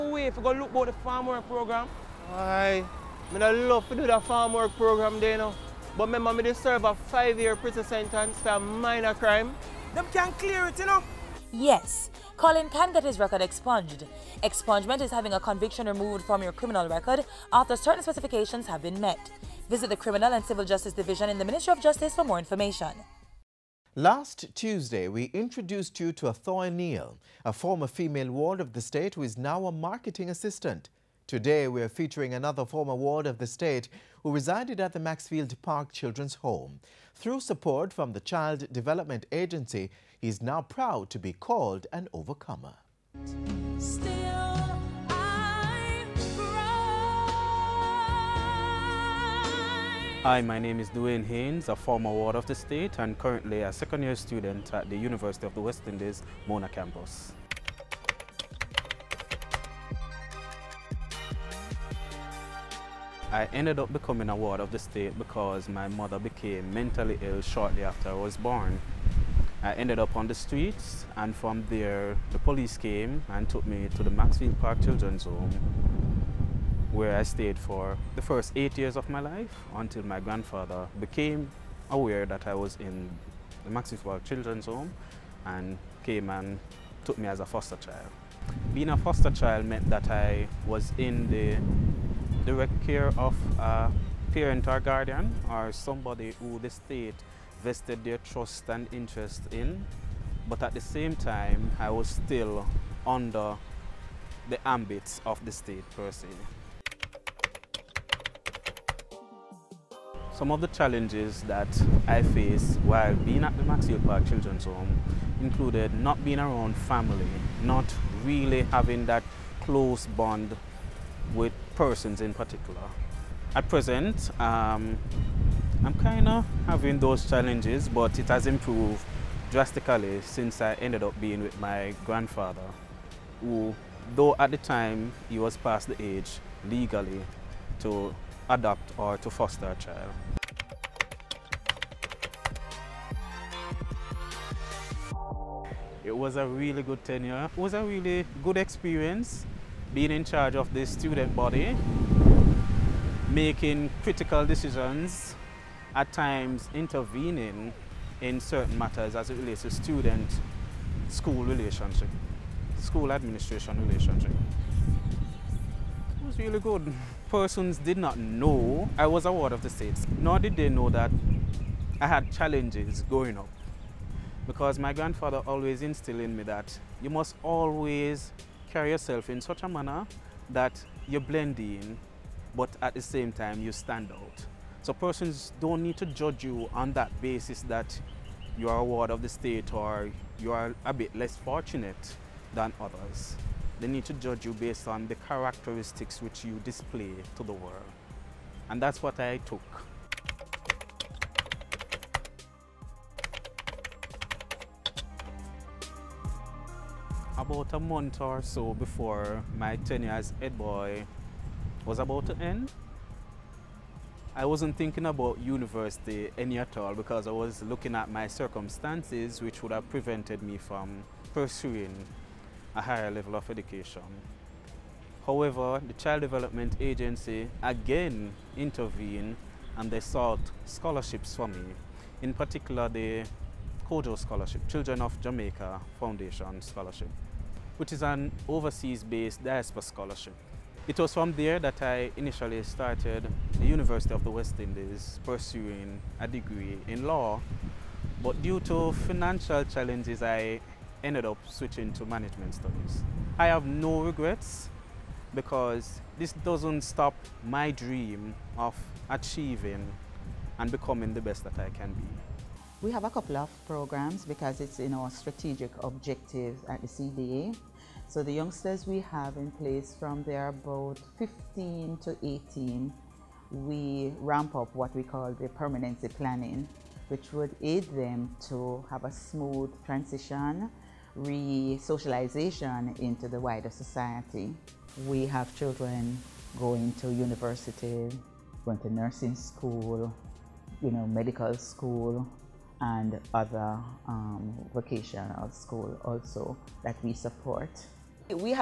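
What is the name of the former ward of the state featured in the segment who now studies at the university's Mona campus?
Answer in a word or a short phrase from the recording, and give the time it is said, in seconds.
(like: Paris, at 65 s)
Duane Haynes, at 50 s.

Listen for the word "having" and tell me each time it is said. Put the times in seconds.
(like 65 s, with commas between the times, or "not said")
15 s, 118 s, 126 s.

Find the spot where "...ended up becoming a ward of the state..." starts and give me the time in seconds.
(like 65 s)
63 s.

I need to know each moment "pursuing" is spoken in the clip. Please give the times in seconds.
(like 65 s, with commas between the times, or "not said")
221 s, 245 s.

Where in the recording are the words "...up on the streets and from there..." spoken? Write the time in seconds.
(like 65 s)
70 s.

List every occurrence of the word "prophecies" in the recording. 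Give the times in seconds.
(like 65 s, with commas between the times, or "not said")
not said.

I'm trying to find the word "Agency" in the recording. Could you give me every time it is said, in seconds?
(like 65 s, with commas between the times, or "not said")
39 s, 226 s.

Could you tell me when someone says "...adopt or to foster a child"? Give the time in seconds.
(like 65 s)
138 s.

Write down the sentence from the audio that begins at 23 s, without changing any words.
Last Tuesday, we introduced you to Athoya Neal, a former female ward of the state who is now a marketing assistant.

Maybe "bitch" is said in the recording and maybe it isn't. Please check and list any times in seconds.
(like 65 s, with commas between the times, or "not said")
not said.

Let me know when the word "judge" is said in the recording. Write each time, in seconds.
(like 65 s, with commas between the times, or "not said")
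186 s, 194 s.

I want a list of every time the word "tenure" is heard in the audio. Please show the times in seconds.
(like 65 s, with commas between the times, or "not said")
147 s, 209 s.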